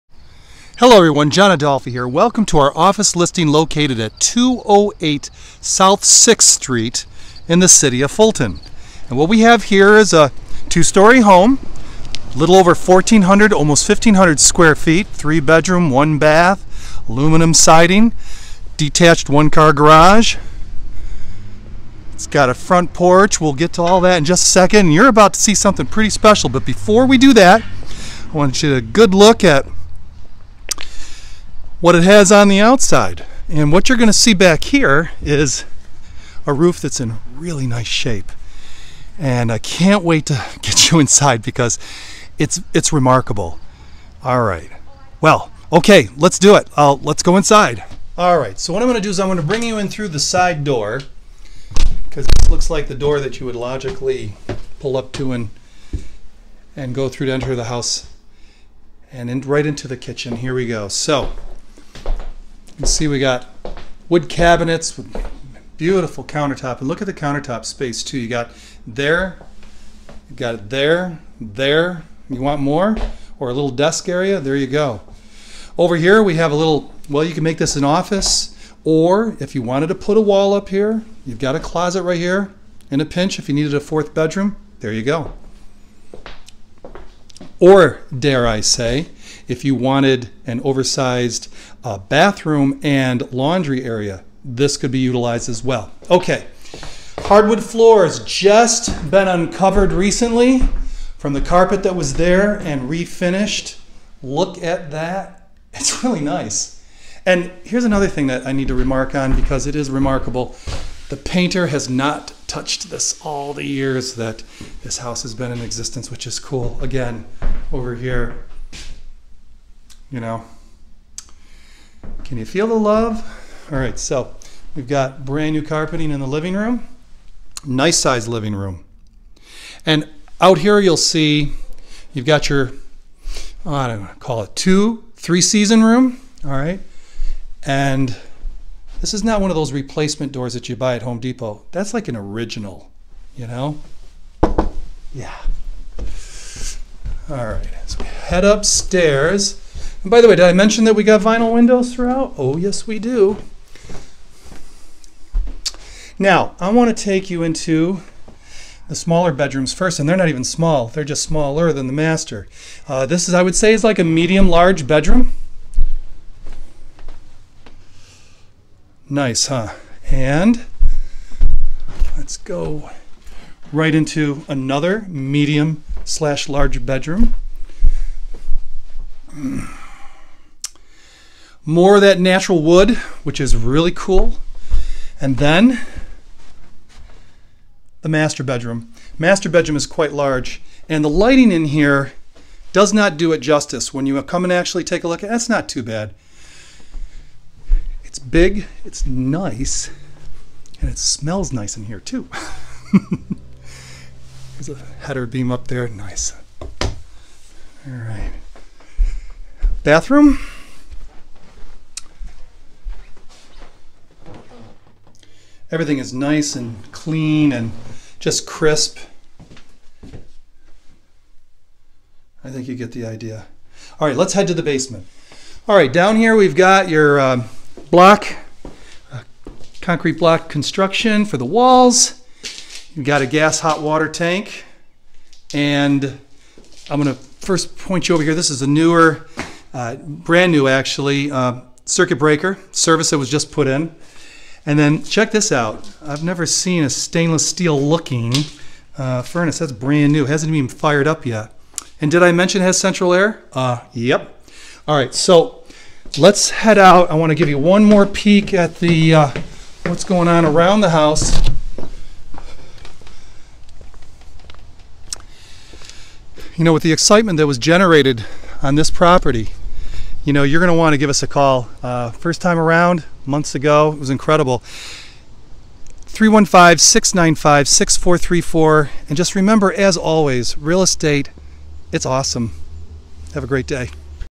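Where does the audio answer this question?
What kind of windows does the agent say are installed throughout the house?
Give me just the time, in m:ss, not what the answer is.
2:31.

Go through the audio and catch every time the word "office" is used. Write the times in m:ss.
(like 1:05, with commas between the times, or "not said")
0:02, 1:17.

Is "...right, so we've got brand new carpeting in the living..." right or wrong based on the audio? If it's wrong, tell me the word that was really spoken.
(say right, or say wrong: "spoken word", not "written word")
right.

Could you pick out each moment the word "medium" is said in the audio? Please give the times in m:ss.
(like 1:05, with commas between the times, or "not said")
2:44, 2:55.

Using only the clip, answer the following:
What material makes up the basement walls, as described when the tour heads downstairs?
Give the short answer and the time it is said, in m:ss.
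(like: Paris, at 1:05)
Concrete block, at 3:49.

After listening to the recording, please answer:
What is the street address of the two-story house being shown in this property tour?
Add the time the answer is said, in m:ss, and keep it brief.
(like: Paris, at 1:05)
208 South 6th Street, at 0:04.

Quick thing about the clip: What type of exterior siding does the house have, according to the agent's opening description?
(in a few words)
Aluminum siding.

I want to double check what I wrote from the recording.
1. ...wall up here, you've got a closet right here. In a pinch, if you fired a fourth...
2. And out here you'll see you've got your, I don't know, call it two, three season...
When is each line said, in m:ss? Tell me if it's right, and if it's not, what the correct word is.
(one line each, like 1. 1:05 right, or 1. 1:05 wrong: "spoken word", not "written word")
1. 1:20 wrong: "needed", not "fired"
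2. 2:09 right.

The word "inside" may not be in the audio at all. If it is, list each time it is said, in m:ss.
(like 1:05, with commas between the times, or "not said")
0:40, 0:47.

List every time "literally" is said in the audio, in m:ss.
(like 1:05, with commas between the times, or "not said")
not said.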